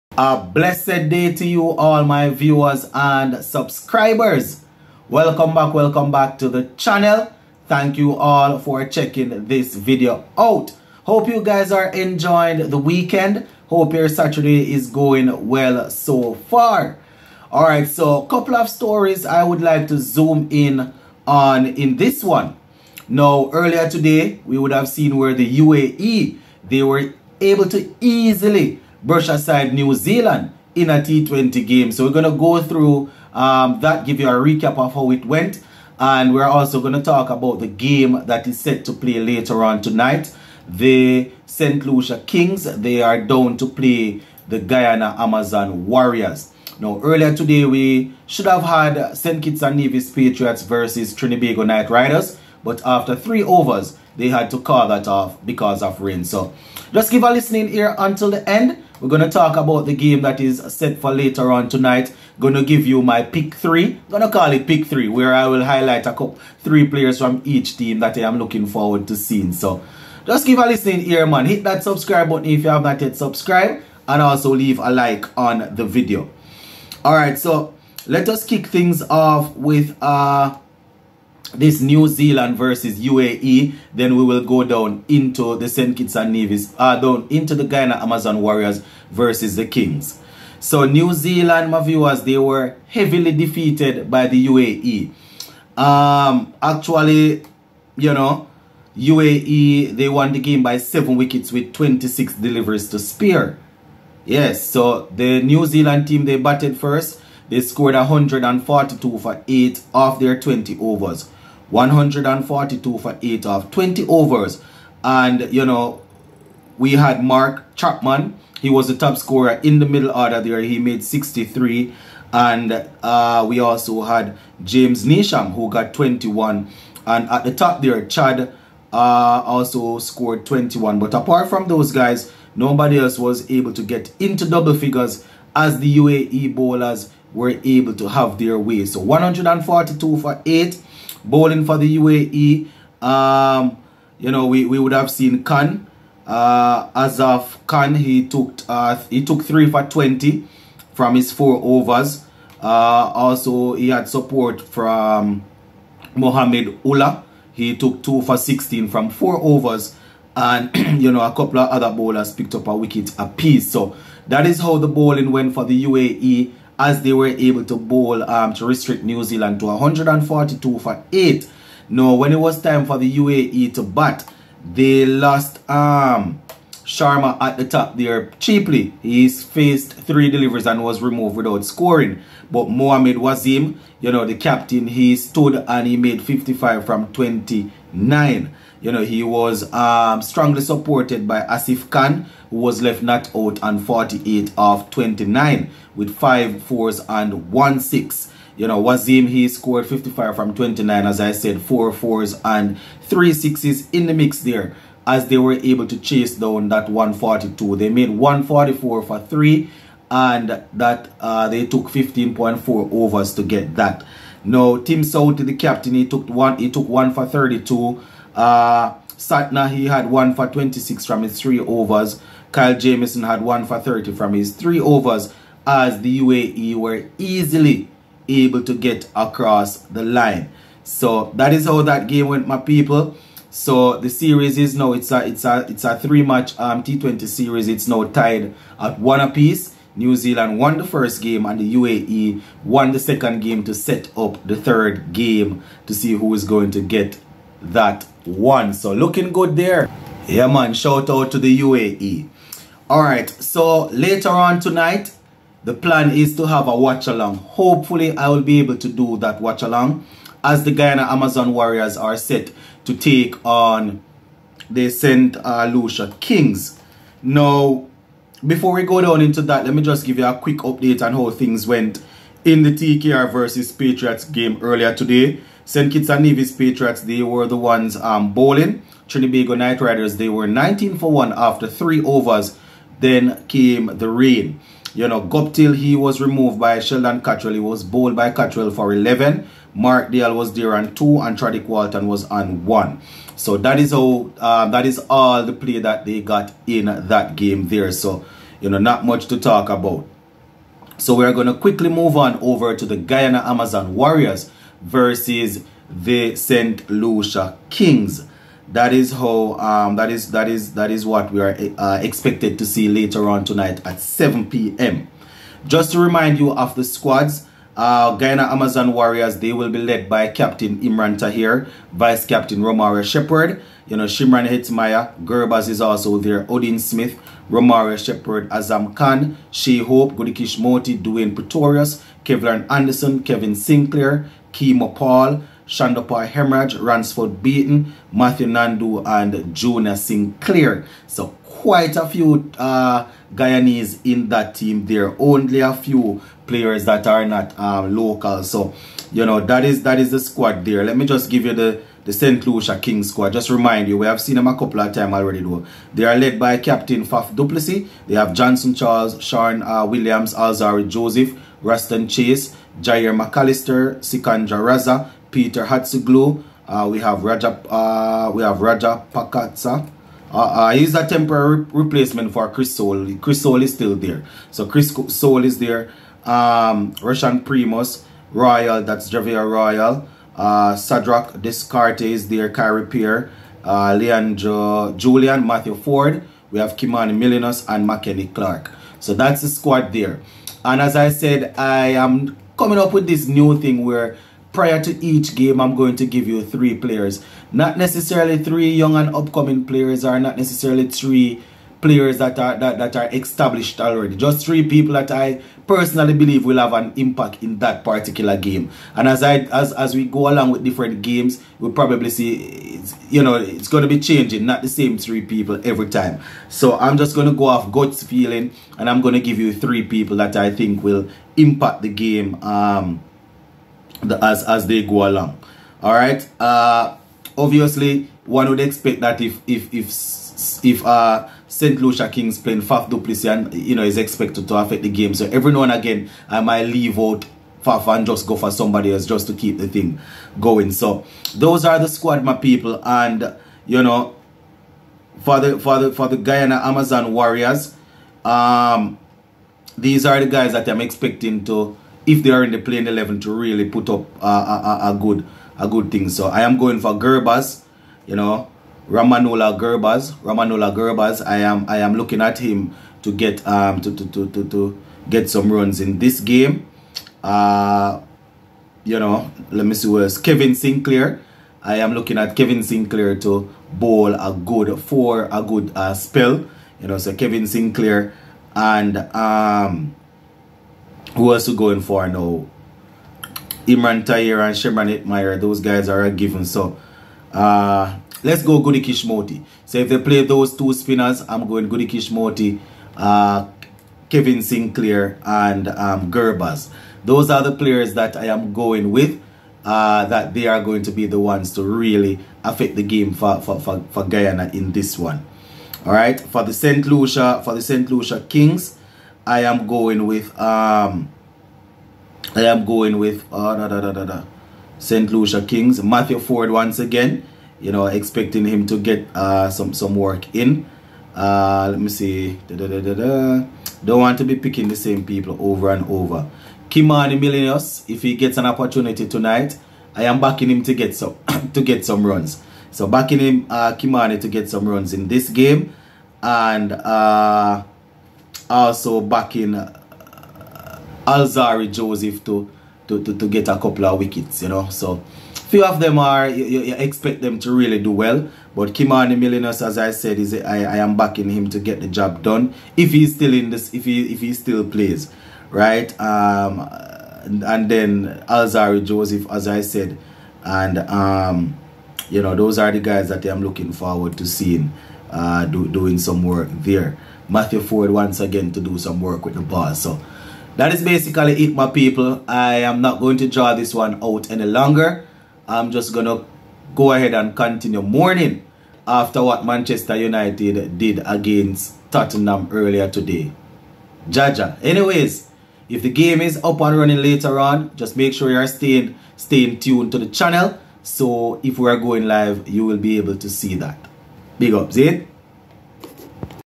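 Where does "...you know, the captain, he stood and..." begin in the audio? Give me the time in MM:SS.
03:03.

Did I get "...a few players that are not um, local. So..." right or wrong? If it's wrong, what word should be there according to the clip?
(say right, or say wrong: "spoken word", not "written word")
right.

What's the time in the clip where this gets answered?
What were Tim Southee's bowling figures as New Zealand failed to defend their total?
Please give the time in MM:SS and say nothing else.
03:36.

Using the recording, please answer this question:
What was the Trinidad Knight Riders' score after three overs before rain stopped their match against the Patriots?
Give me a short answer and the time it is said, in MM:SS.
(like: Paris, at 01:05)
19 for 1, at 04:40.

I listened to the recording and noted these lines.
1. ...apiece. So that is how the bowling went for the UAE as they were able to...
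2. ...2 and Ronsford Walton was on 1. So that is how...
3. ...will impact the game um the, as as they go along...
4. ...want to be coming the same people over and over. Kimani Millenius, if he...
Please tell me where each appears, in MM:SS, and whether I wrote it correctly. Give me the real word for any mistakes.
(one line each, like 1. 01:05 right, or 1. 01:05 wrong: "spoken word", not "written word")
1. 02:43 right
2. 04:50 wrong: "Tradic", not "Ronsford"
3. 07:00 right
4. 08:43 wrong: "picking", not "coming".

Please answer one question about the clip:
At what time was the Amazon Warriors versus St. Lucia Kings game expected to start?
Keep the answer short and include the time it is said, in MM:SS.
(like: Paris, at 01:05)
7 p.m., at 05:13.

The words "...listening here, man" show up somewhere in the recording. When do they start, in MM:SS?
01:10.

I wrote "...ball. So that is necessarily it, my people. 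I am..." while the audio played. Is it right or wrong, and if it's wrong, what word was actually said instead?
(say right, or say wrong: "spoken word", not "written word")
wrong: "basically", not "necessarily".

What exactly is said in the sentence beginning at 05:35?
Shonda Hemorrhage, Ronsford Beaton, Matthew Nandu, and Jonah Sinclair.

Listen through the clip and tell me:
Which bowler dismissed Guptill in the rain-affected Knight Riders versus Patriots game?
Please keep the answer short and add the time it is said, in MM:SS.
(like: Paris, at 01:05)
Sheldon Cottrell, at 04:46.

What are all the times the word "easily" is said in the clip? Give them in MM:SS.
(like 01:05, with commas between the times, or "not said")
00:28, 03:47.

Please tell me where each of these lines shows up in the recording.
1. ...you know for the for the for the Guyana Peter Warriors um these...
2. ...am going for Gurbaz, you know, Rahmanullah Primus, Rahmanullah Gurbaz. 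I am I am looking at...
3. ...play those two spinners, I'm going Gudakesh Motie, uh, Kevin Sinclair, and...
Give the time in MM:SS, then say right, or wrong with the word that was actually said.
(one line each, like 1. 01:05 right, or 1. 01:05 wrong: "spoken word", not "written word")
1. 07:23 wrong: "Amazon", not "Peter"
2. 07:36 wrong: "Gurbaz", not "Primus"
3. 08:09 right.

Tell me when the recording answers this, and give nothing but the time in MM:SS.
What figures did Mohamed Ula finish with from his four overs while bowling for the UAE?
02:38.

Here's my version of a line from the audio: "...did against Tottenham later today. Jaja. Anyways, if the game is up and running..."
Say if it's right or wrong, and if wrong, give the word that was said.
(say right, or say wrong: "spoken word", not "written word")
wrong: "earlier", not "later".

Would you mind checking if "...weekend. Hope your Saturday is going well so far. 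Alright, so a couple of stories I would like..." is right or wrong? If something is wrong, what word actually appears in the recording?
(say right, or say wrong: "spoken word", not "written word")
right.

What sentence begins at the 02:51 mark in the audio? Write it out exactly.
Now, when it was time for the UAE to bat, they lost um, Sharma at the top there cheaply.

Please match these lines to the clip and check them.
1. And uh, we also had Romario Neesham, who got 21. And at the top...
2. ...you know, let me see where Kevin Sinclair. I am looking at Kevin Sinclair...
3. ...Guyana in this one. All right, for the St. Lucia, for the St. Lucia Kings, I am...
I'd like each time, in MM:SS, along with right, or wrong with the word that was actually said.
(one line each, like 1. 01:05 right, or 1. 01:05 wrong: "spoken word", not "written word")
1. 02:02 wrong: "James", not "Romario"
2. 07:48 right
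3. 08:24 right.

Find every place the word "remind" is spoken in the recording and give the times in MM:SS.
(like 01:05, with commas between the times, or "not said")
05:15, 05:53.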